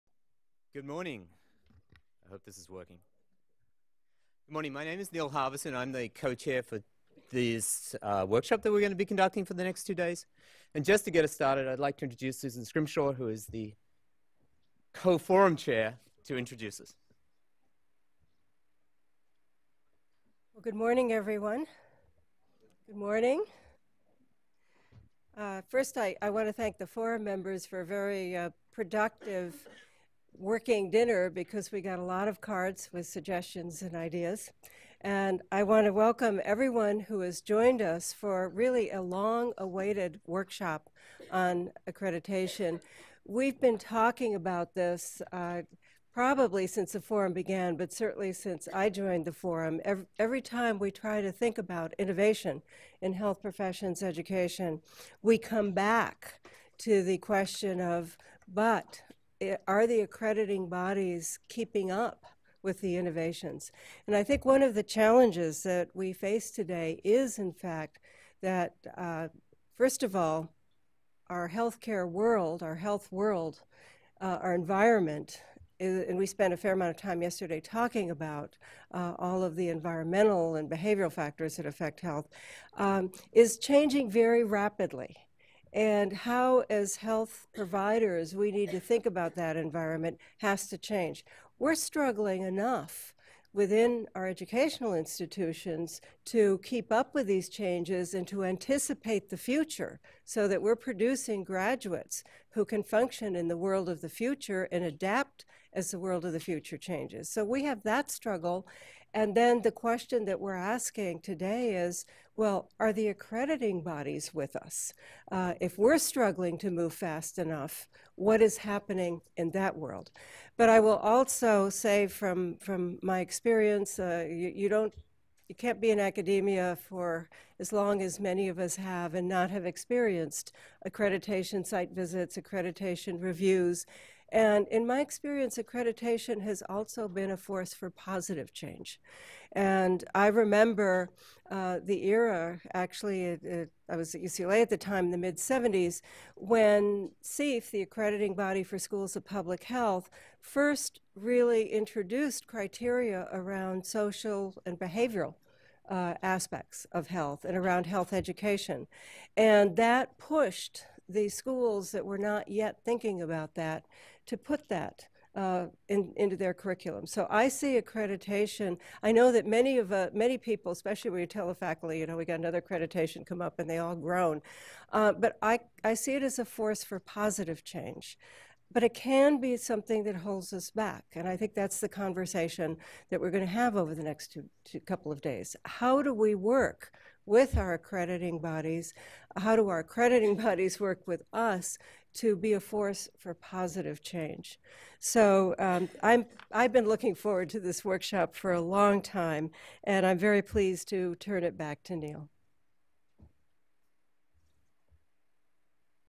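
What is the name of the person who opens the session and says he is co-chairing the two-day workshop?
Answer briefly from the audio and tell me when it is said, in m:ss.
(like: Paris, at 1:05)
Neil Harvison, at 0:05.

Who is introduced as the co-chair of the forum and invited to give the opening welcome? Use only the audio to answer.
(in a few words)
Susan Scrimshaw.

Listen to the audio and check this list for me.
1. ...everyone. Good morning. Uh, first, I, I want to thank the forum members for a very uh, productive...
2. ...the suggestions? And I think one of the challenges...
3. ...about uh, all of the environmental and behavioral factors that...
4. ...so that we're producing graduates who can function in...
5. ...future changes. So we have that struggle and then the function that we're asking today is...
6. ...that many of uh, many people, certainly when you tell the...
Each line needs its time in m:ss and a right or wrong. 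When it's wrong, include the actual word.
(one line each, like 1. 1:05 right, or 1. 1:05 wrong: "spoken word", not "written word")
1. 0:21 right
2. 1:02 wrong: "innovations", not "suggestions"
3. 1:18 right
4. 1:40 right
5. 1:46 wrong: "question", not "function"
6. 2:49 wrong: "especially", not "certainly".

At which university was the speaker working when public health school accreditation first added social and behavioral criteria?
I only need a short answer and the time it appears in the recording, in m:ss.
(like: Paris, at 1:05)
UCLA, at 2:24.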